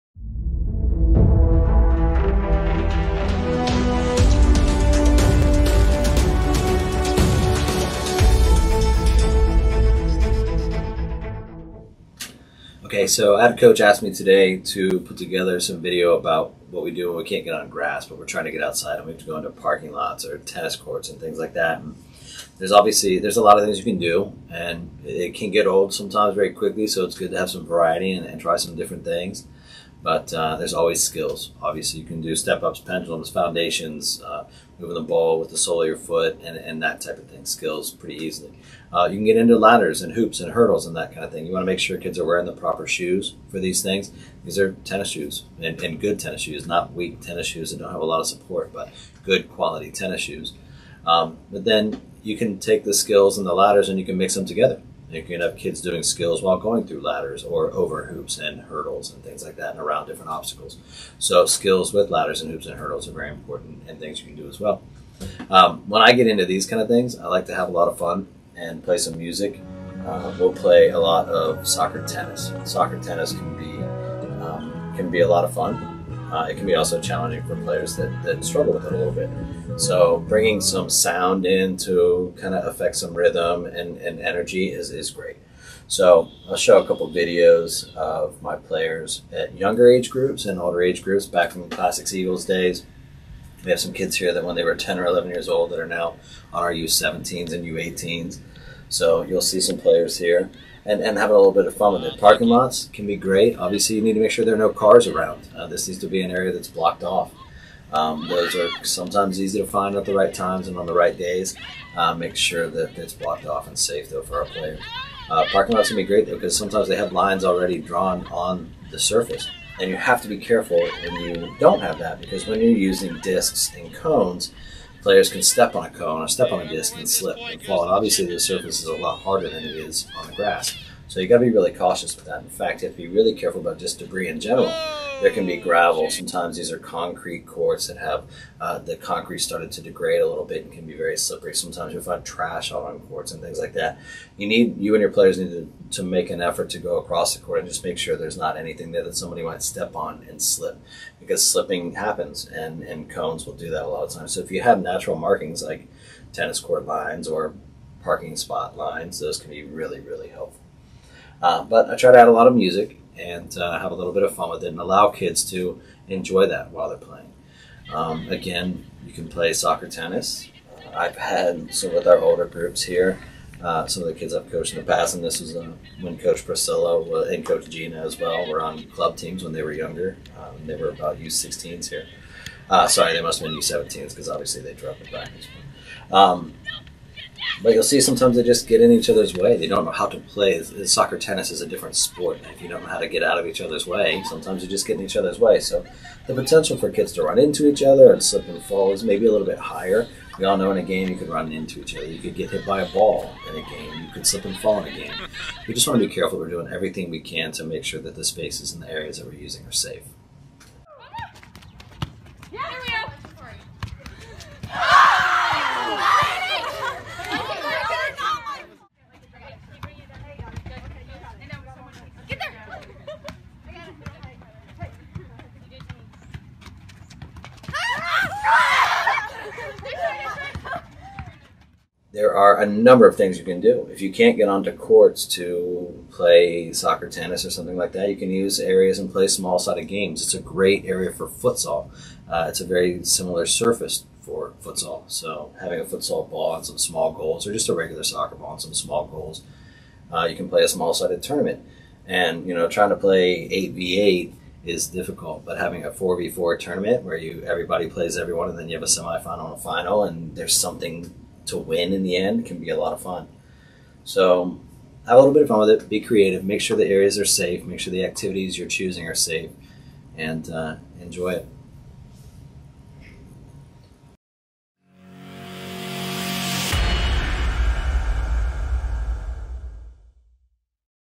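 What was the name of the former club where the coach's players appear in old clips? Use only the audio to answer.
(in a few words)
Classics Eagles.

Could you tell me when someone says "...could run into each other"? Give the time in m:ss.
3:21.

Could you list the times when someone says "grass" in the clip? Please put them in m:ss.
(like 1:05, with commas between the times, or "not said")
0:17, 2:10.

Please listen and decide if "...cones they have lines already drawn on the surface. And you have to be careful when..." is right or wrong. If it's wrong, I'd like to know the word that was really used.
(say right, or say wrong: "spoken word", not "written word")
wrong: "sometimes", not "cones".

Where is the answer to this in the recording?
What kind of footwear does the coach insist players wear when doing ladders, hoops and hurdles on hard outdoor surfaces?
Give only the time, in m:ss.
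0:49.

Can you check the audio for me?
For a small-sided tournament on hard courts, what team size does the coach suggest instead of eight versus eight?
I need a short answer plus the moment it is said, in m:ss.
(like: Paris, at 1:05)
4 v 4, at 4:15.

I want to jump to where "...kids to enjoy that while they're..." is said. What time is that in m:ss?
2:45.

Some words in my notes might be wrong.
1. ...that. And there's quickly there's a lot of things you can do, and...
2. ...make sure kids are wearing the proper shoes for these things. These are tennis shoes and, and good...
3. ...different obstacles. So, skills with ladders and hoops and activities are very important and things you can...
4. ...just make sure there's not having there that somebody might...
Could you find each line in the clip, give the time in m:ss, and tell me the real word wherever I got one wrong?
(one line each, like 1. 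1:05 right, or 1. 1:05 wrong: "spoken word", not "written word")
1. 0:21 wrong: "obviously", not "quickly"
2. 0:41 right
3. 1:00 wrong: "hurdles", not "activities"
4. 2:27 wrong: "anything", not "having".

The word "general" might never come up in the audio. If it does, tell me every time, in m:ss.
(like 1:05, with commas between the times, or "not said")
2:14.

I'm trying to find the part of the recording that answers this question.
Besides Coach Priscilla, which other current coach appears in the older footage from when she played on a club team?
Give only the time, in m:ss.
2:57.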